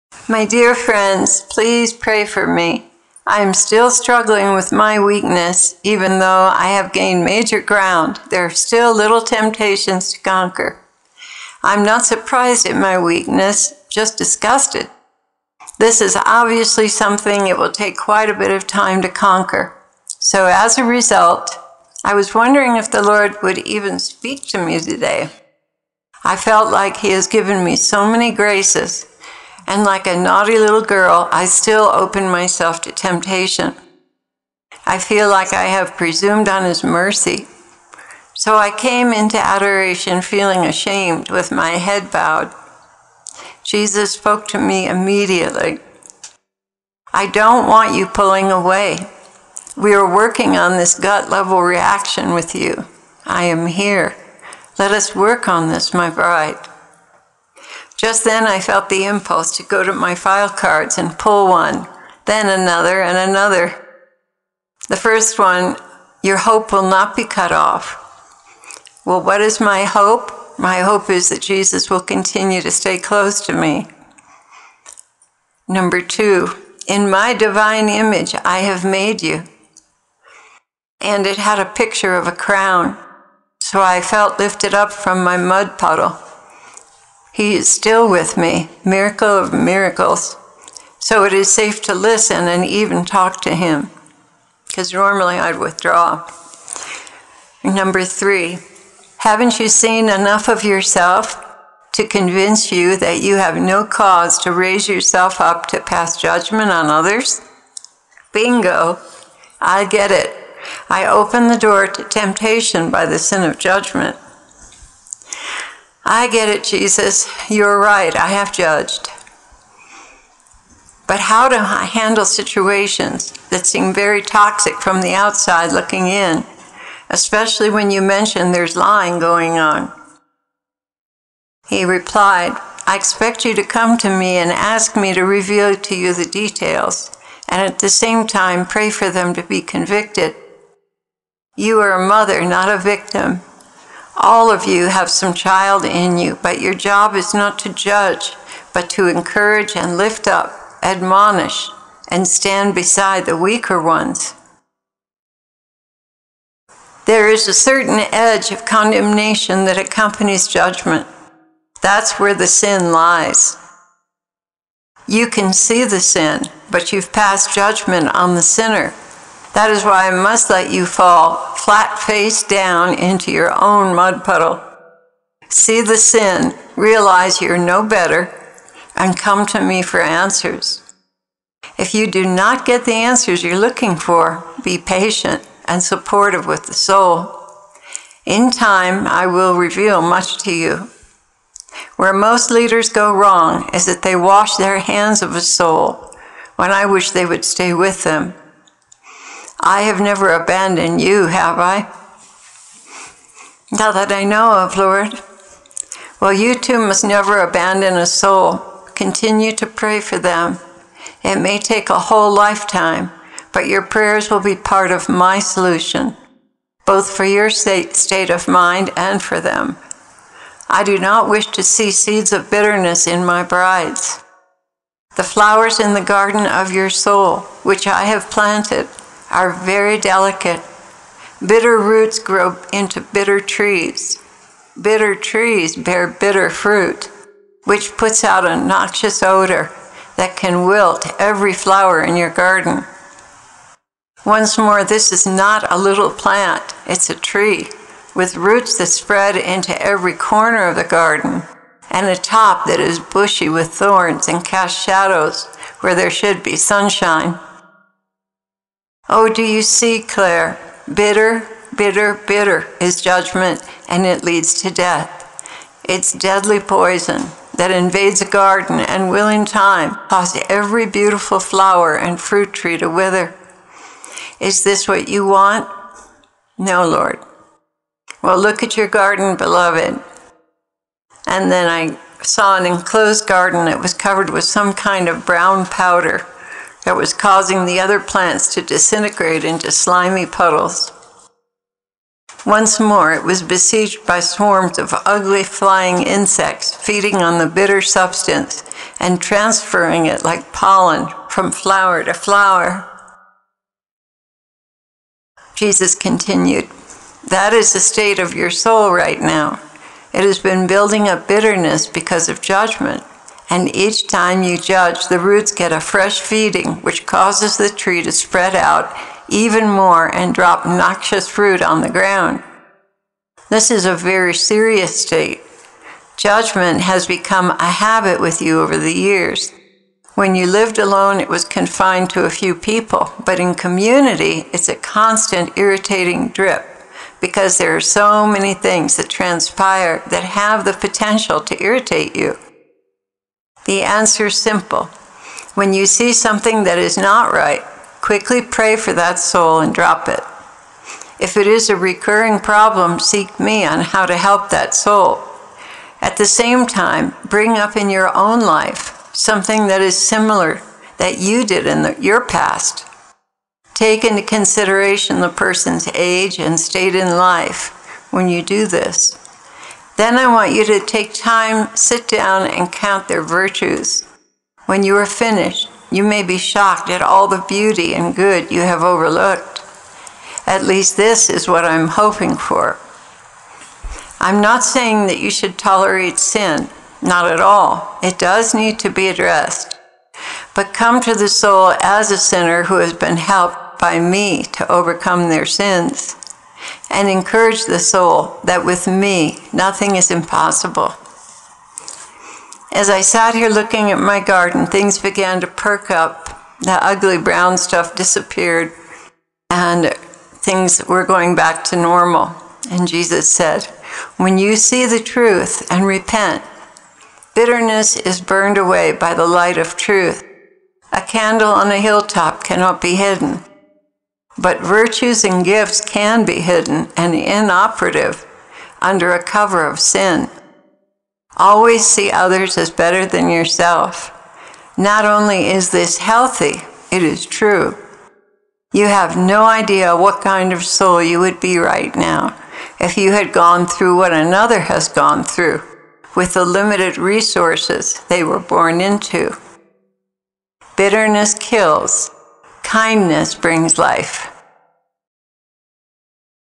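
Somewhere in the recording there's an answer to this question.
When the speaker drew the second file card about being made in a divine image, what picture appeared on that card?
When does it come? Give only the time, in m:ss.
1:22.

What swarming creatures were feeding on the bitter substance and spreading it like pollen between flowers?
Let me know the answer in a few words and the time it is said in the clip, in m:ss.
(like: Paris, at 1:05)
Flying insects, at 4:55.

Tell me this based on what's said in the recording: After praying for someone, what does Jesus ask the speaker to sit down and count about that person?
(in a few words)
Their virtues.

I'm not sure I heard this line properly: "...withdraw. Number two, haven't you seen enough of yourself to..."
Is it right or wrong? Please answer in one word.
wrong.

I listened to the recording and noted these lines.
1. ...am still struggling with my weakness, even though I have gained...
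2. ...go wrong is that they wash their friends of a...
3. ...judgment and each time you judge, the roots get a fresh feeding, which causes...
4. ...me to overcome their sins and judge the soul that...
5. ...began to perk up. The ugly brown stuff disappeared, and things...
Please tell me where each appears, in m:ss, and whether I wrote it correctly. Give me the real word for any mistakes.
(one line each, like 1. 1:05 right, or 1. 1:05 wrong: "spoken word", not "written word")
1. 0:03 right
2. 3:12 wrong: "hands", not "friends"
3. 5:12 right
4. 6:33 wrong: "encourage", not "judge"
5. 6:44 right.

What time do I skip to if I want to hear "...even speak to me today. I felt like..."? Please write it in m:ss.
0:23.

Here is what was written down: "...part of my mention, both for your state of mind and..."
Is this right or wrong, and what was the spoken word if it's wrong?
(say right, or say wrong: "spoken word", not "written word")
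wrong: "solution", not "mention".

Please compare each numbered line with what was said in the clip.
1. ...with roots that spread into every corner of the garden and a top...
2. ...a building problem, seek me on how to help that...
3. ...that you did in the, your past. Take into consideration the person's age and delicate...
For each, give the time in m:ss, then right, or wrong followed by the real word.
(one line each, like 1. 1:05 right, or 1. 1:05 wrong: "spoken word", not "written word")
1. 4:08 right
2. 5:51 wrong: "recurring", not "building"
3. 6:00 wrong: "state", not "delicate".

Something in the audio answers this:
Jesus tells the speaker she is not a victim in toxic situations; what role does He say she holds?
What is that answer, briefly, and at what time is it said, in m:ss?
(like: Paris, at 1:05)
A mother, at 2:21.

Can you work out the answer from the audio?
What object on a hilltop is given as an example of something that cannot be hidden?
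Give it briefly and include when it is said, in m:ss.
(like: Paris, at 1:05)
A candle, at 7:00.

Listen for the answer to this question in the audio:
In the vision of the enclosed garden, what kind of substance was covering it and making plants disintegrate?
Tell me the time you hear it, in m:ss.
4:45.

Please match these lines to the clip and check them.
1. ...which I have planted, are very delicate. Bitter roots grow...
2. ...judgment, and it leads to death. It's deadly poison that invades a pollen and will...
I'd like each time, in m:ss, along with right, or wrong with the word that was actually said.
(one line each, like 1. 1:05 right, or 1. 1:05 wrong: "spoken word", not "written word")
1. 3:47 right
2. 4:23 wrong: "garden", not "pollen".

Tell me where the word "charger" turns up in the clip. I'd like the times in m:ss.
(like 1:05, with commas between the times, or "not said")
not said.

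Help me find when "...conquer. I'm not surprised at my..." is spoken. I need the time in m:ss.
0:10.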